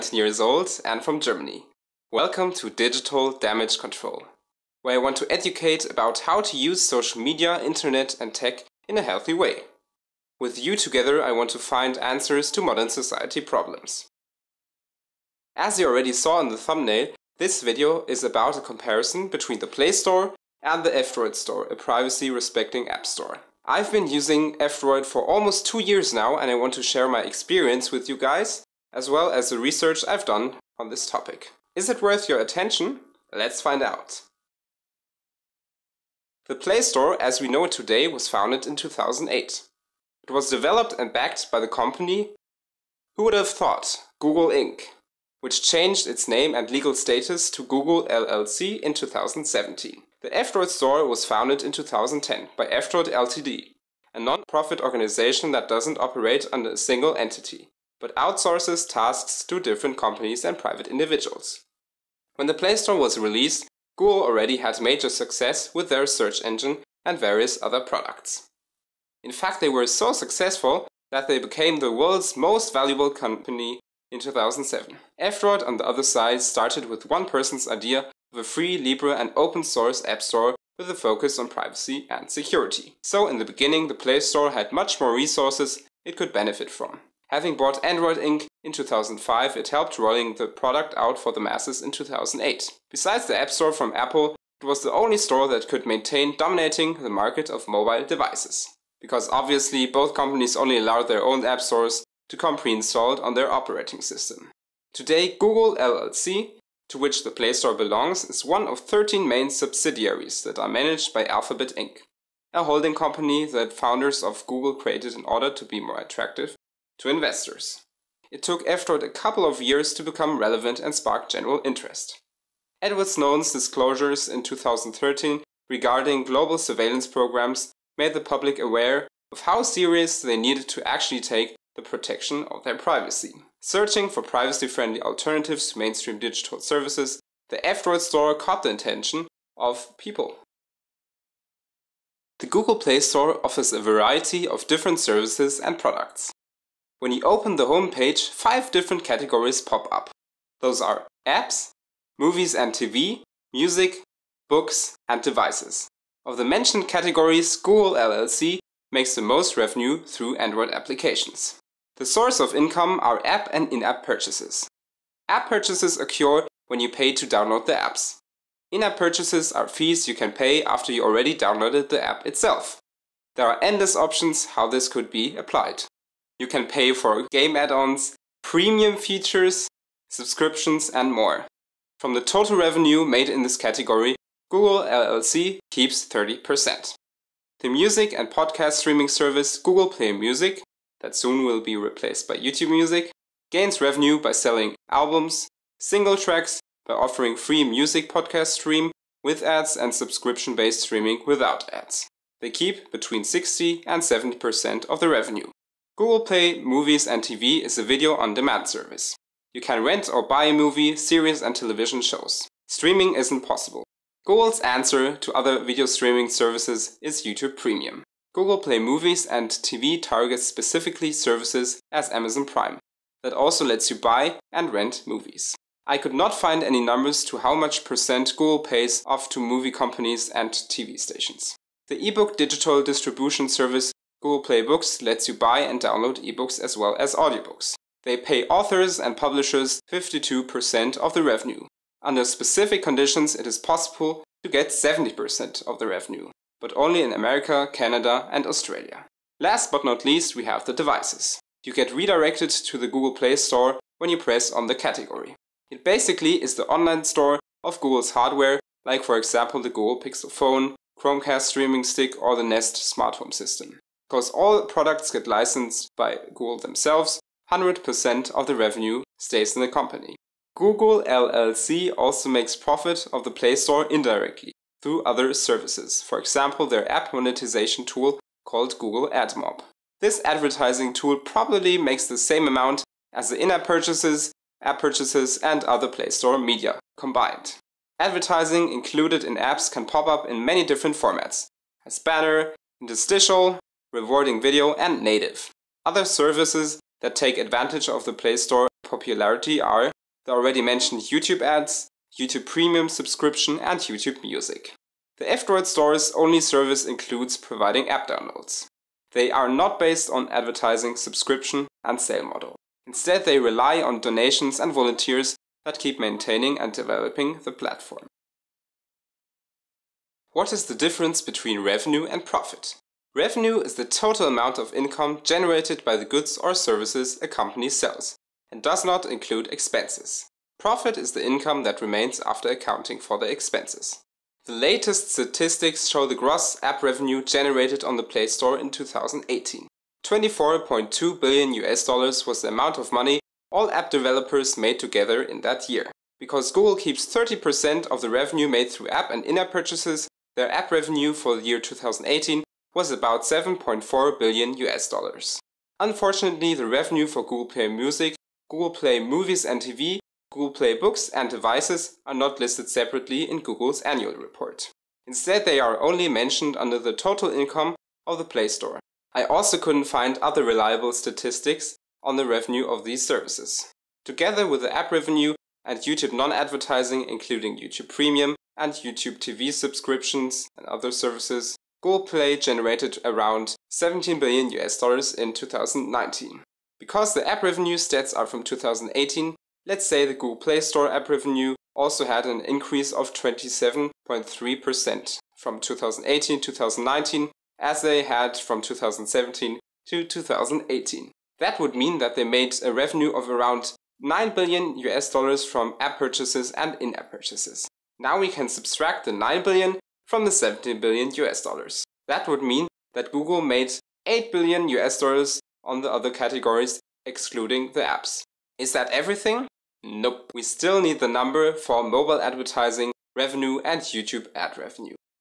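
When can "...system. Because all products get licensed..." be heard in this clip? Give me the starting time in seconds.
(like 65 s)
263 s.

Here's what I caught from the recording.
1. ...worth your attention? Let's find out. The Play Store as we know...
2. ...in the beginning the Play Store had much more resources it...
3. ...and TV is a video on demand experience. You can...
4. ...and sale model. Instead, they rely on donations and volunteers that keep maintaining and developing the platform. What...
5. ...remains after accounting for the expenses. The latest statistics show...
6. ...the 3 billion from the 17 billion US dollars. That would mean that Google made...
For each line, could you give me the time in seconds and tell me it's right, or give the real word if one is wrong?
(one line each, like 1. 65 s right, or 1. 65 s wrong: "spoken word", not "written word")
1. 32 s right
2. 83 s right
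3. 207 s wrong: "service", not "experience"
4. 311 s right
5. 331 s right
6. 409 s wrong: "9", not "3".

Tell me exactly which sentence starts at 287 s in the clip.
Advertising included in apps can pop up in many different formats, as banner, interstitial, rewarding video and native.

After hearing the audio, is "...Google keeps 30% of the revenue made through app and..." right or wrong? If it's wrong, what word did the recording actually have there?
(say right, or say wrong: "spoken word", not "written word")
right.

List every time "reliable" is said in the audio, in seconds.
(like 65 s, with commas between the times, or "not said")
370 s.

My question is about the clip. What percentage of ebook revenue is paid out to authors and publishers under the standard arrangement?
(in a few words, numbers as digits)
52%.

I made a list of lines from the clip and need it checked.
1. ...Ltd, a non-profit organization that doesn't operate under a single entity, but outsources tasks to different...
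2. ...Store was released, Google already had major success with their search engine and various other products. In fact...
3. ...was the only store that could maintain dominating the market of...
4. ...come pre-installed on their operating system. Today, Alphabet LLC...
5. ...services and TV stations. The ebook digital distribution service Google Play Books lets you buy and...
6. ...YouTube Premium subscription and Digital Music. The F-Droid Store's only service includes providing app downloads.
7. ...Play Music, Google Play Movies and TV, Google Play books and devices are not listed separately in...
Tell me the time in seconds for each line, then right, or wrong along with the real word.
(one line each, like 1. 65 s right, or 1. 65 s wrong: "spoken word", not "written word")
1. 53 s right
2. 62 s right
3. 94 s right
4. 102 s wrong: "Google", not "Alphabet"
5. 229 s wrong: "companies", not "services"
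6. 302 s wrong: "YouTube", not "Digital"
7. 357 s right.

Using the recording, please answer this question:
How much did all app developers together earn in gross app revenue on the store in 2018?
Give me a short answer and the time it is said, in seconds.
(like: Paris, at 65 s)
24.2 billion US dollars, at 340 s.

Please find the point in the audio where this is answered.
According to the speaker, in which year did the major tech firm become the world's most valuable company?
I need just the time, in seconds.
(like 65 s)
74 s.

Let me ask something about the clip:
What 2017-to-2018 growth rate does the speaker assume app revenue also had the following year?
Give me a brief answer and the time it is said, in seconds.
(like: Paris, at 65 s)
27.3%, at 393 s.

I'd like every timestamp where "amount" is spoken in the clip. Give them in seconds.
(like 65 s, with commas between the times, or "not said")
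282 s, 324 s, 342 s.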